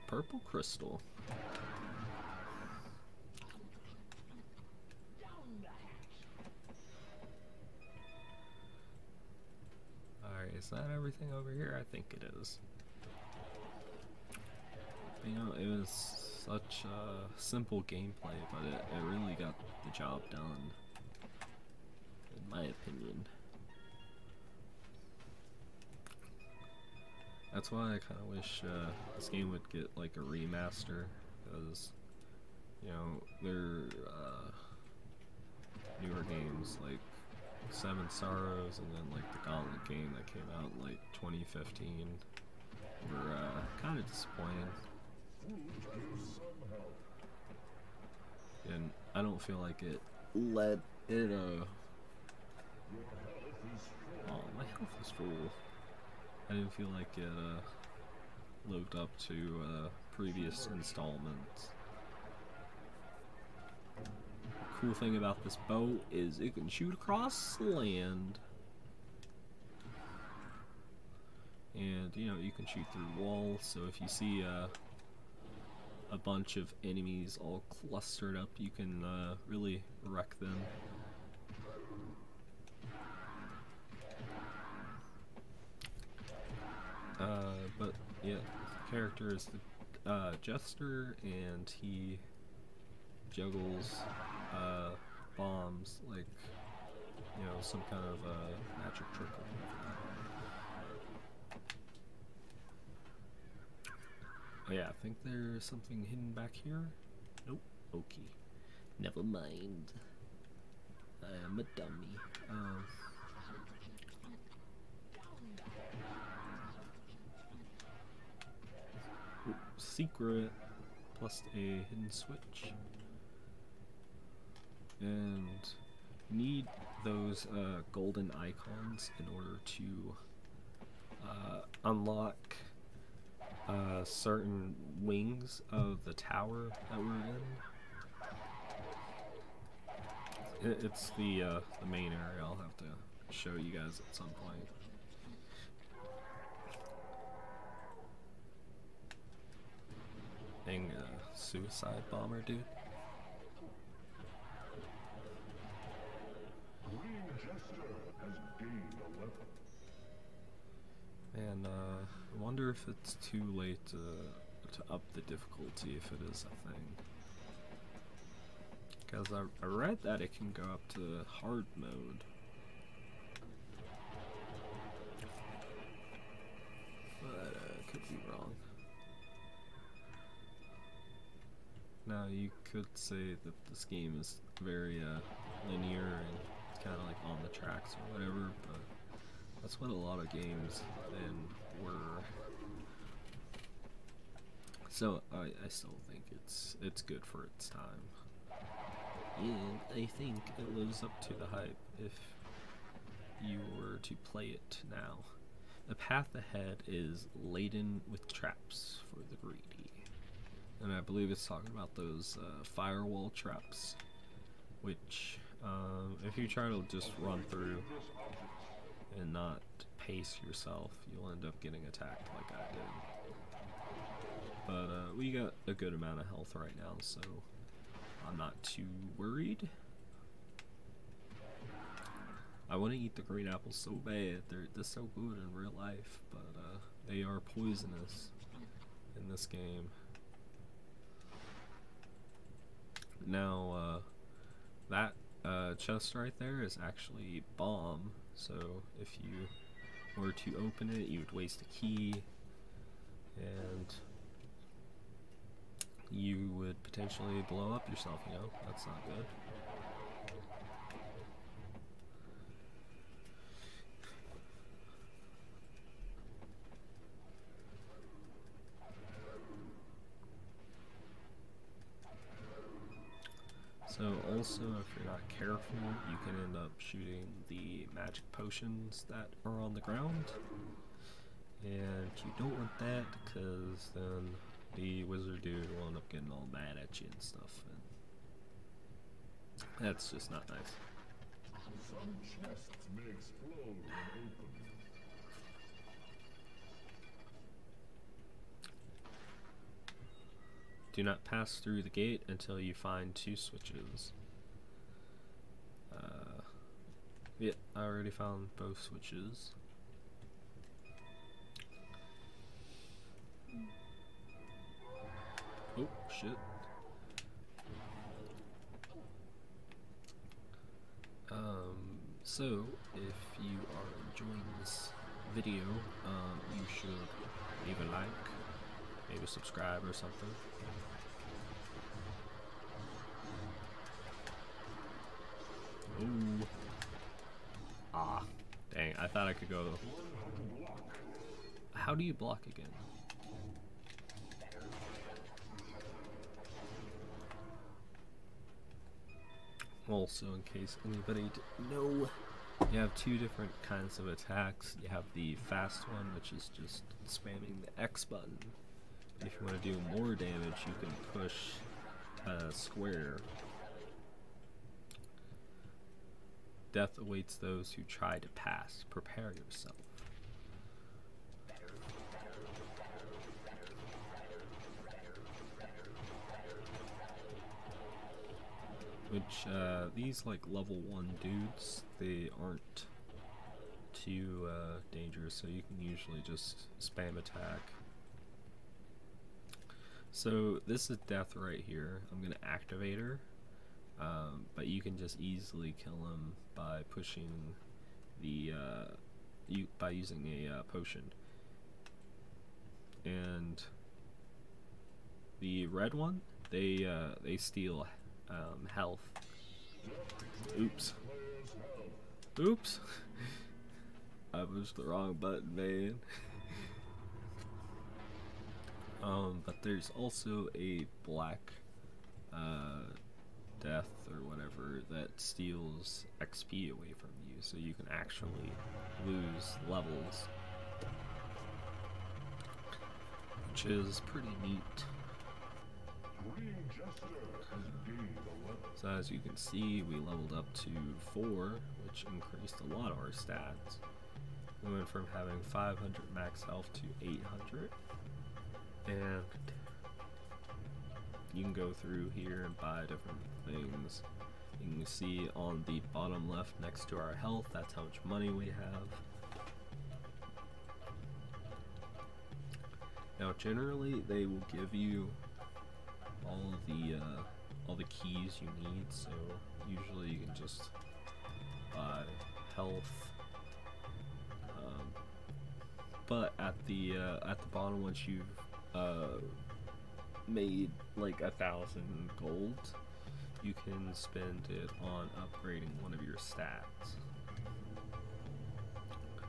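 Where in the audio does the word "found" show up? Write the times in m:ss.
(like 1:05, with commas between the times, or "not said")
5:08.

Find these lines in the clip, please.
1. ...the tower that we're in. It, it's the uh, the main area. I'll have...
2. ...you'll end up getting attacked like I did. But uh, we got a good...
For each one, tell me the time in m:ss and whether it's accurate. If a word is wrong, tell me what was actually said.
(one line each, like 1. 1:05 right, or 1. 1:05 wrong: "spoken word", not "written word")
1. 2:16 right
2. 3:41 right.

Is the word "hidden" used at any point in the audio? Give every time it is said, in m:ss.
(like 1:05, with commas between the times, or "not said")
1:46, 2:01.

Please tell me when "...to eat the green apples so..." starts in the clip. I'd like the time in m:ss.
3:52.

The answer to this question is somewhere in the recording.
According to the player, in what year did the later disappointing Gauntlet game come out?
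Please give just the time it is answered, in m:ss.
0:41.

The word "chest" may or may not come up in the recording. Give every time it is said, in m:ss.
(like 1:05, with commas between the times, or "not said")
4:05, 4:52.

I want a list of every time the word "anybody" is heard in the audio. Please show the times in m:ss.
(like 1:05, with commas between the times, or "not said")
5:50.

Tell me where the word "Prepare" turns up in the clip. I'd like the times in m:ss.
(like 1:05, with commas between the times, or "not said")
6:08.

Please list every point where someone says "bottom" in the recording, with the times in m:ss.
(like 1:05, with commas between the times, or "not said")
7:35, 7:57.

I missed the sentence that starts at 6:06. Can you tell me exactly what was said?
Death awaits those who try to pass.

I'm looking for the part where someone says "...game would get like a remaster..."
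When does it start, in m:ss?
0:29.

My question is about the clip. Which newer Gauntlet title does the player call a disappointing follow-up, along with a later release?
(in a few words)
Seven Sorrows.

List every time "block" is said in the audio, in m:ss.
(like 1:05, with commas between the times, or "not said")
5:42.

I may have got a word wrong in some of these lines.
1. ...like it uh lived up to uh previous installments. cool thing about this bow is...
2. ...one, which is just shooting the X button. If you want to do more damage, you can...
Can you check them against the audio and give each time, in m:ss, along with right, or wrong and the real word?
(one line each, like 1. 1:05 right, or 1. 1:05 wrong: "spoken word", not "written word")
1. 0:56 right
2. 5:55 wrong: "spamming", not "shooting".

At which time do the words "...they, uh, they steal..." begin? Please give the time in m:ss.
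6:46.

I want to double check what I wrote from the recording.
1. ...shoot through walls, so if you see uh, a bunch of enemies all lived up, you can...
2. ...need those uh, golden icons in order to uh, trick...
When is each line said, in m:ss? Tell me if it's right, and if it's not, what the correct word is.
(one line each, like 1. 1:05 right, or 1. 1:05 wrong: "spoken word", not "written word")
1. 1:12 wrong: "clustered", not "lived"
2. 2:06 wrong: "unlock", not "trick".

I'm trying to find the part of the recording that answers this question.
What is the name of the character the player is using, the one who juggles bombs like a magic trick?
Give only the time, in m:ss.
1:30.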